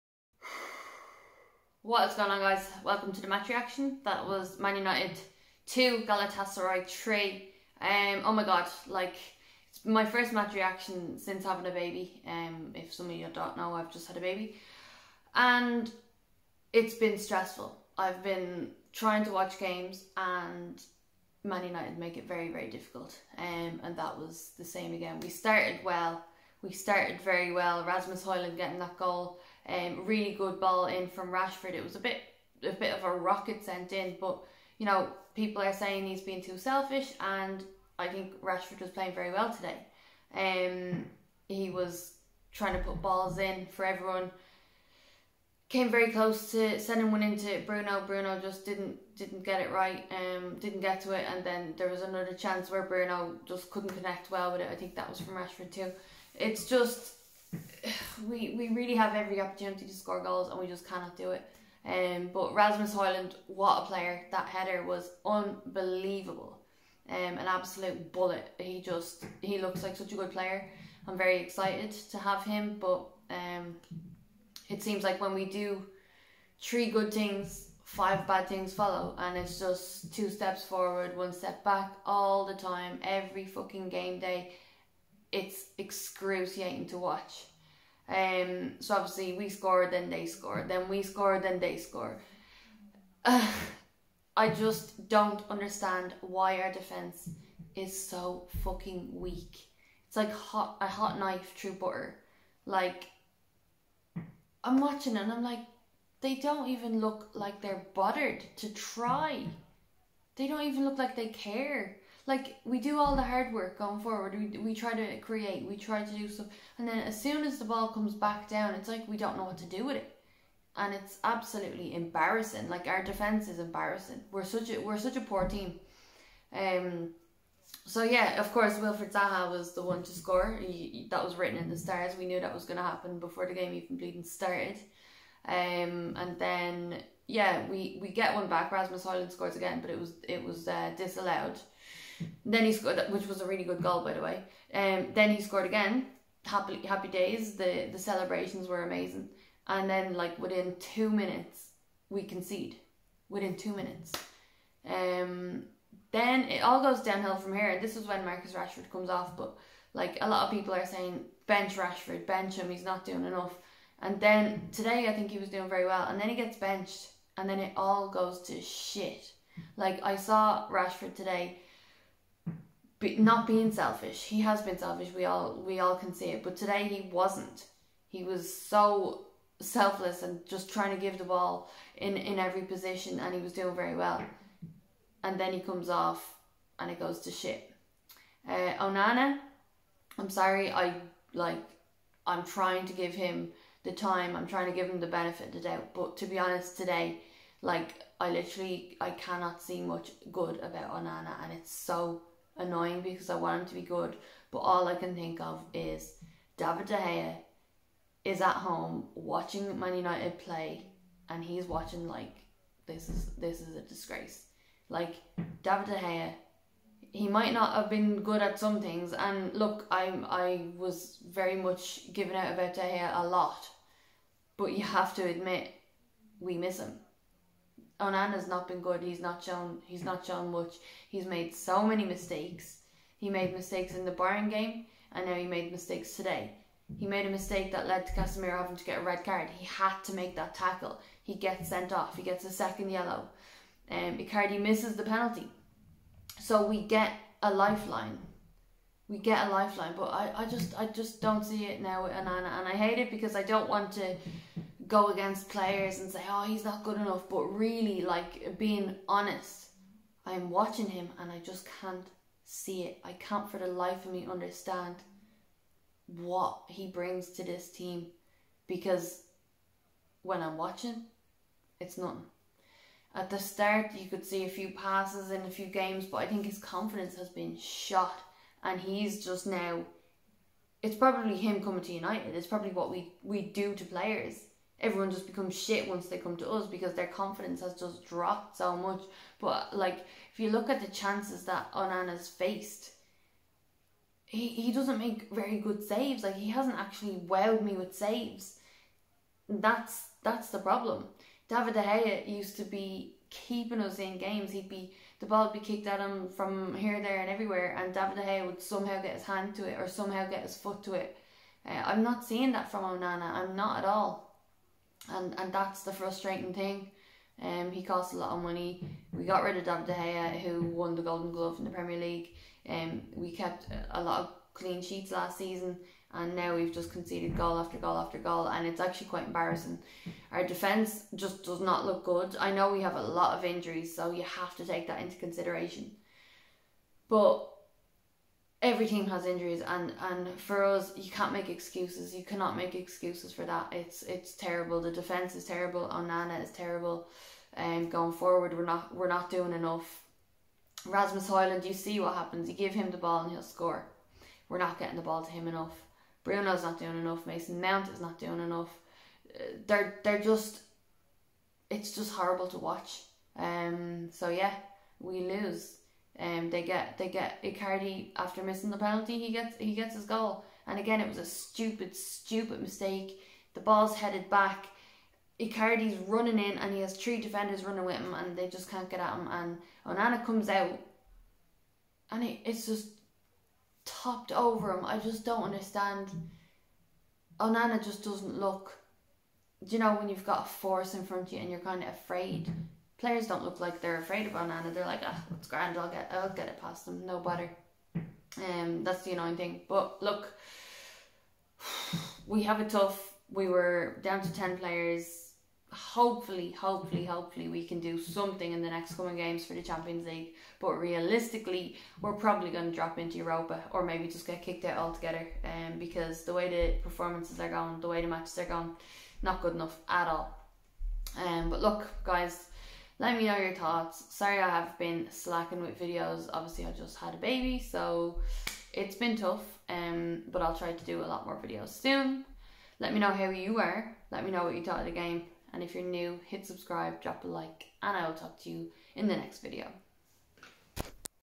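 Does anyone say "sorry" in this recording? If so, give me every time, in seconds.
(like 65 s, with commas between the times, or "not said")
190 s, 424 s.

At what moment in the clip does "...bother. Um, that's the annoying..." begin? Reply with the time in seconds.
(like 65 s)
397 s.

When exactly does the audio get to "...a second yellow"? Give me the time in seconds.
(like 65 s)
242 s.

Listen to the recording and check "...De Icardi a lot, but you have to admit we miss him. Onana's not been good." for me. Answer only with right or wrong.
wrong.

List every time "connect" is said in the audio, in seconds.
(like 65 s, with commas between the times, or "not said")
53 s.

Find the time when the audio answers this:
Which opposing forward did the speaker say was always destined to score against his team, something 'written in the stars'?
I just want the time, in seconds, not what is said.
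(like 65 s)
128 s.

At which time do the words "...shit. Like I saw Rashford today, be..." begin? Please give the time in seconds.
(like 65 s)
168 s.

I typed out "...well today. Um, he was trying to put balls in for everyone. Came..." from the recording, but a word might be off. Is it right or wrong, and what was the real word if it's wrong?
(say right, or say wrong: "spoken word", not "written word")
right.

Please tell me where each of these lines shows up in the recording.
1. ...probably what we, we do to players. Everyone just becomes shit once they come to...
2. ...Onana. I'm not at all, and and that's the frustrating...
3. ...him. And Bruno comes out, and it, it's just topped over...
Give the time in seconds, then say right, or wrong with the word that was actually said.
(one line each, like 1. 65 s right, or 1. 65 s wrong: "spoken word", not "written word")
1. 282 s right
2. 312 s right
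3. 379 s wrong: "Onana", not "Bruno".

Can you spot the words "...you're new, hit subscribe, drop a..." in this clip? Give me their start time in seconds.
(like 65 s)
435 s.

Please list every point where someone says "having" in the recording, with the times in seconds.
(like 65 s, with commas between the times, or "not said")
11 s, 238 s.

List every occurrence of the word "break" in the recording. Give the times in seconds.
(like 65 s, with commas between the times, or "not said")
not said.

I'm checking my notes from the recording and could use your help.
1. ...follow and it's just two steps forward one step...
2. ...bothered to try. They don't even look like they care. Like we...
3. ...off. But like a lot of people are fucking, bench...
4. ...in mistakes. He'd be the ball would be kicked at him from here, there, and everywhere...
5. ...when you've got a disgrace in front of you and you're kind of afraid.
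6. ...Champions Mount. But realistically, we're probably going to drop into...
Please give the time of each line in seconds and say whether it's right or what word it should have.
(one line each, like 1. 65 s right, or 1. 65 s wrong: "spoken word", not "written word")
1. 78 s right
2. 107 s right
3. 159 s wrong: "saying", not "fucking"
4. 303 s wrong: "games", not "mistakes"
5. 389 s wrong: "force", not "disgrace"
6. 409 s wrong: "League", not "Mount".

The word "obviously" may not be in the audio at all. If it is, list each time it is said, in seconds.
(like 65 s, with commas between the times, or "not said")
88 s, 426 s.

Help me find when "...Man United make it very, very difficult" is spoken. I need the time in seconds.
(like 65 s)
21 s.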